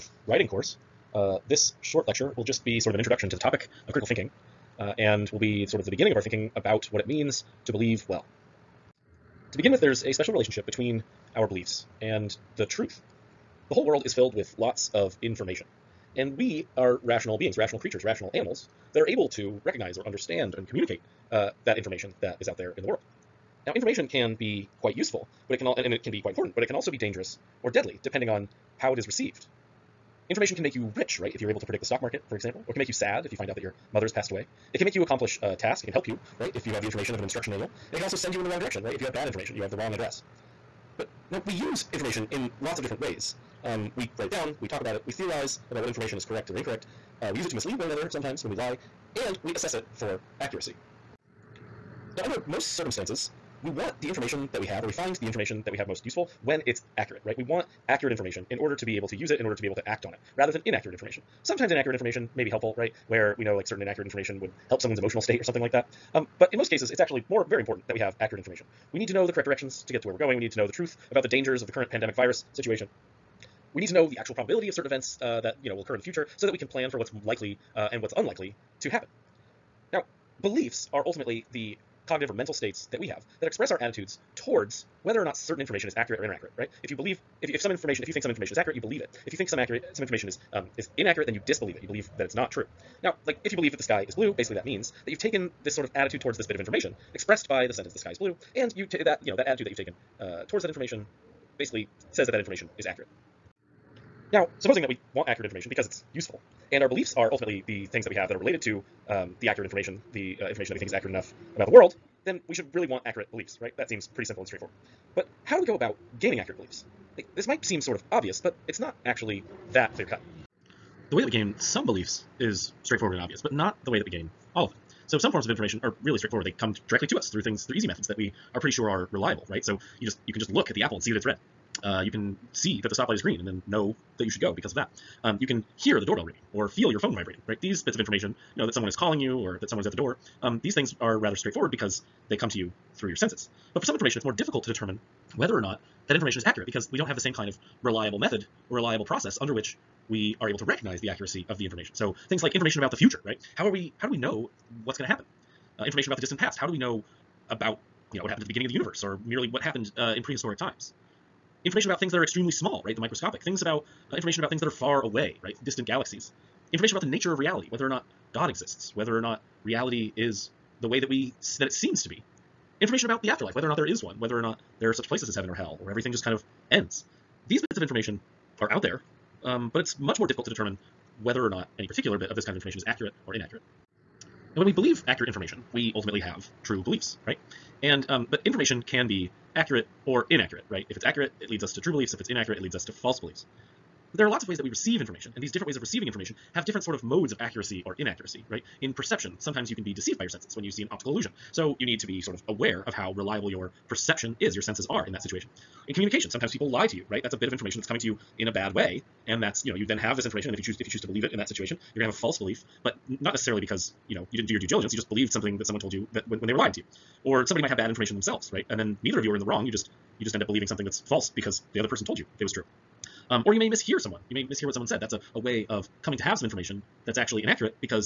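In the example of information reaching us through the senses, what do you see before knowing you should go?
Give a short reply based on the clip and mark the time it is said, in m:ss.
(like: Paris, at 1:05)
stoplight is green, at 2:12.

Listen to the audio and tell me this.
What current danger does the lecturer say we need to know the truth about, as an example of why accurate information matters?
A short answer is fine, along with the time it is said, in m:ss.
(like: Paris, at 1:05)
pandemic virus situation, at 1:11.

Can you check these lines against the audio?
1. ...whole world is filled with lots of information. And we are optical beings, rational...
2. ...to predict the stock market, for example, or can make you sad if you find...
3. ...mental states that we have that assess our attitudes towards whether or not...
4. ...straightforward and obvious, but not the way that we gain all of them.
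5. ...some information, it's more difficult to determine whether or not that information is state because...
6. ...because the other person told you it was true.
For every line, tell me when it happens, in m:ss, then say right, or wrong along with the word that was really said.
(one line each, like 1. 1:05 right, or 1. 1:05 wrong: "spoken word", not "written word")
1. 0:13 wrong: "rational", not "optical"
2. 0:31 right
3. 1:22 wrong: "express", not "assess"
4. 2:02 right
5. 2:23 wrong: "accurate", not "state"
6. 3:41 right.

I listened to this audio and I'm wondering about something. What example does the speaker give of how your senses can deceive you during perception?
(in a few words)
an optical illusion.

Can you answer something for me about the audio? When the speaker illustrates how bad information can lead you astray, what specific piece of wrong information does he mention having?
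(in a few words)
the wrong address.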